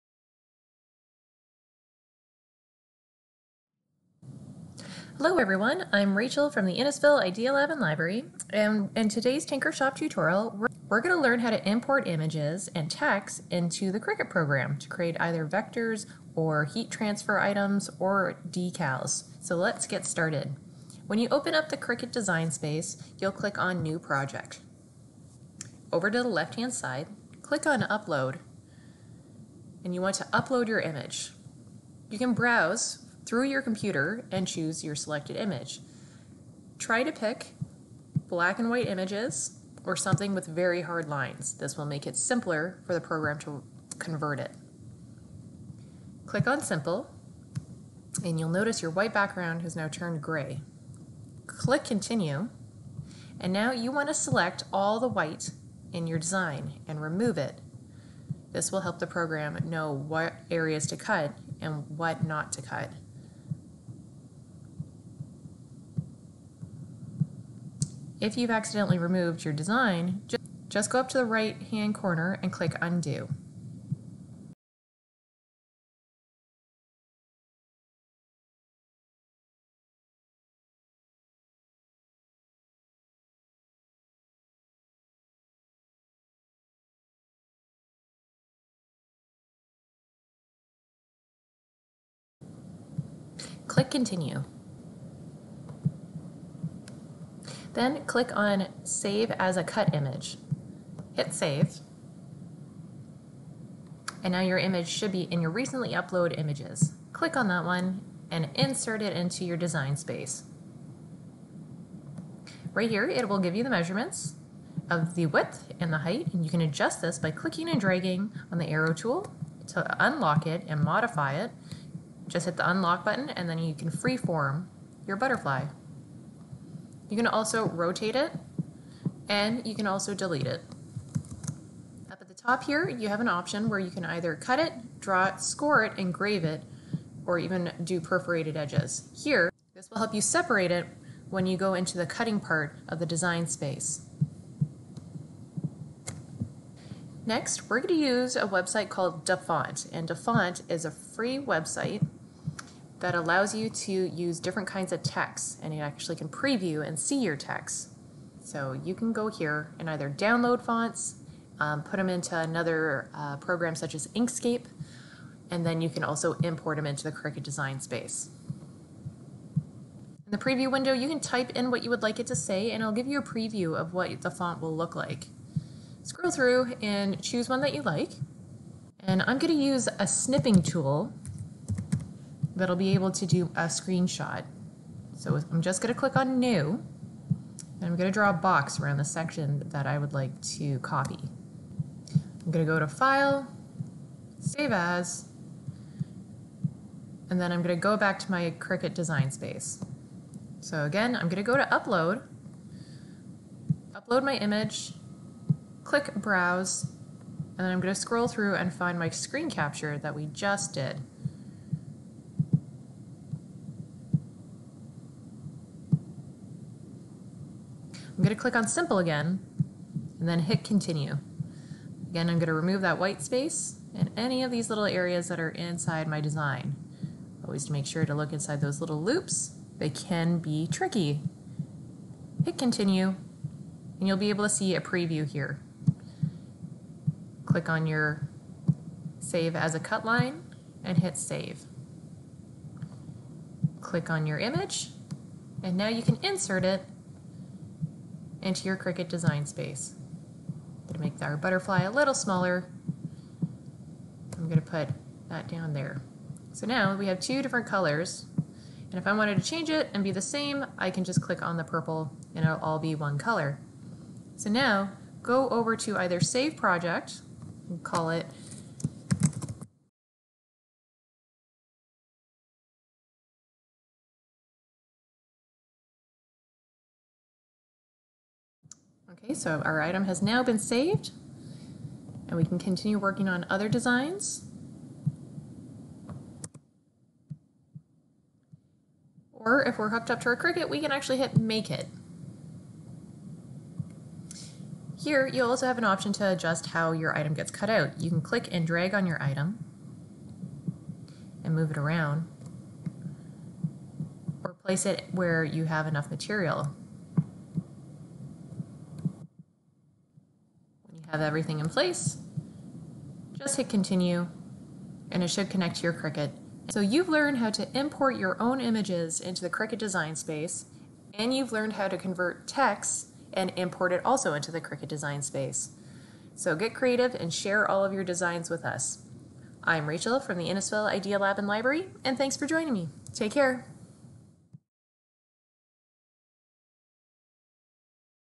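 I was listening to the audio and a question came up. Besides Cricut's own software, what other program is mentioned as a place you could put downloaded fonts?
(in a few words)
Inkscape.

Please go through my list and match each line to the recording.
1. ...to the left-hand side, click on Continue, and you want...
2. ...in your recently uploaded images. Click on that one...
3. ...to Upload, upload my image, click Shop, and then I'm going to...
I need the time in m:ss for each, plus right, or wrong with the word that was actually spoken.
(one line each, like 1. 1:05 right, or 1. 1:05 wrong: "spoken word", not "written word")
1. 0:26 wrong: "Upload", not "Continue"
2. 1:45 right
3. 3:21 wrong: "Browse", not "Shop".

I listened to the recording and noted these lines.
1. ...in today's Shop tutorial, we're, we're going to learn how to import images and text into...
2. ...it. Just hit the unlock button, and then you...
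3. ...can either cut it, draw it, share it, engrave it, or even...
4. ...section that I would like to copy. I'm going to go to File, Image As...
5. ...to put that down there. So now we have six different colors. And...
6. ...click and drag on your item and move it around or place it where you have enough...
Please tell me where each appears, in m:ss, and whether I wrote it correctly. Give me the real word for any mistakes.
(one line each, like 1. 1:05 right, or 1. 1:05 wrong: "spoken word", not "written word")
1. 0:08 right
2. 2:01 right
3. 2:13 wrong: "score", not "share"
4. 3:09 wrong: "Save", not "Image"
5. 4:14 wrong: "two", not "six"
6. 4:58 right.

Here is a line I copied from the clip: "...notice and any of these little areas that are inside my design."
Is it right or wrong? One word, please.
wrong.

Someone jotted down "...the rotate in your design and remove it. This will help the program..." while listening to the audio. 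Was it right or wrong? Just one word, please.
wrong.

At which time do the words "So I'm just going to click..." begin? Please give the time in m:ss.
3:05.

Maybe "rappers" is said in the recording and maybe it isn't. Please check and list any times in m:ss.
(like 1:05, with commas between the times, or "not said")
not said.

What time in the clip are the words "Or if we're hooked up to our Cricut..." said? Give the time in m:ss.
4:49.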